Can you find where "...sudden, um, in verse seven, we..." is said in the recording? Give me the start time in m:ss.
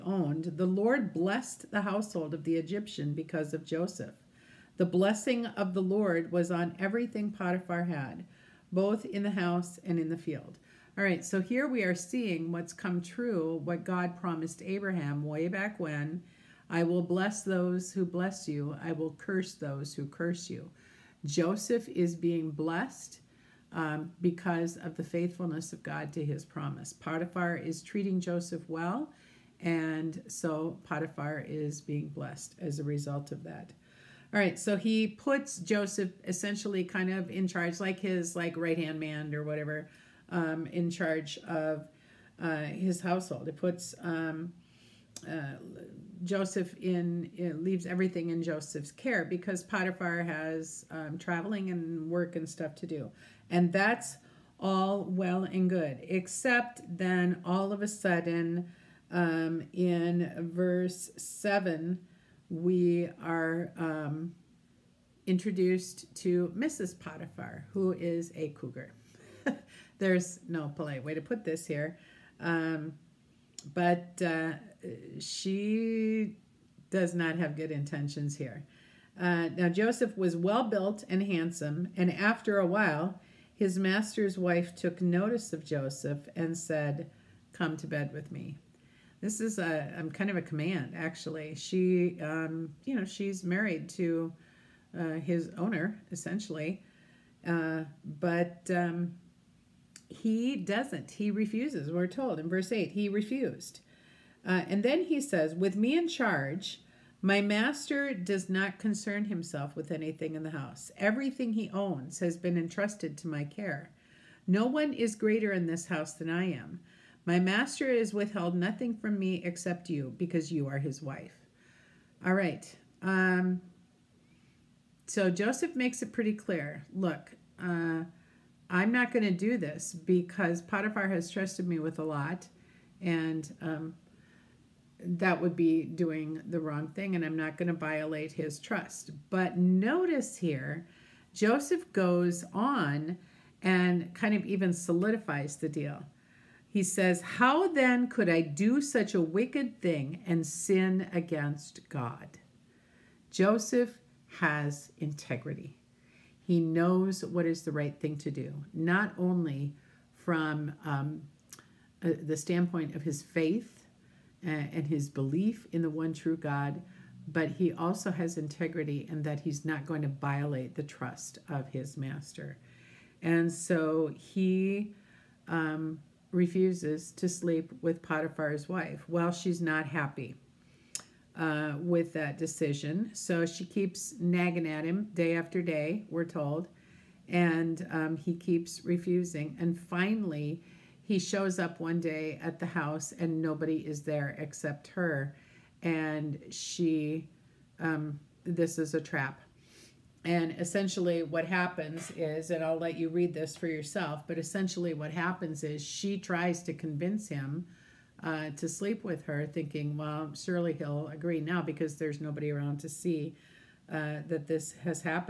0:57.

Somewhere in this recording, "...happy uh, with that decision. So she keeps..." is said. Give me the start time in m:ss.
2:59.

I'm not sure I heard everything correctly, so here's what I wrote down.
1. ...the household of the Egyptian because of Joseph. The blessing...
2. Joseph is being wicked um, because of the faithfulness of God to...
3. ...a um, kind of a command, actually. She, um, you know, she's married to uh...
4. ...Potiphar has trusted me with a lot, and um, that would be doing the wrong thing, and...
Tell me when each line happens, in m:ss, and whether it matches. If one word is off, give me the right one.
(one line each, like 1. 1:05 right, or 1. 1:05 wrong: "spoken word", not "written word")
1. 0:01 right
2. 0:21 wrong: "blessed", not "wicked"
3. 1:29 right
4. 2:10 right.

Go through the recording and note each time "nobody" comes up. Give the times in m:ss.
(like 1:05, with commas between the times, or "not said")
3:13, 3:32.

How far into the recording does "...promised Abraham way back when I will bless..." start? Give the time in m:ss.
0:14.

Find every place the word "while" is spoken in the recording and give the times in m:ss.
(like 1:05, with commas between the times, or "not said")
1:22, 2:59.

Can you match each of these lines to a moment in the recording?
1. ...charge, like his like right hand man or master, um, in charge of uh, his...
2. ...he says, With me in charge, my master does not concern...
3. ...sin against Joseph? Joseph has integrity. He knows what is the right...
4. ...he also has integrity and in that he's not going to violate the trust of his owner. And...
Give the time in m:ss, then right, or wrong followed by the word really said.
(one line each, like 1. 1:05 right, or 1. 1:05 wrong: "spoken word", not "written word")
1. 0:37 wrong: "whatever", not "master"
2. 1:45 right
3. 2:30 wrong: "God", not "Joseph"
4. 2:47 wrong: "master", not "owner".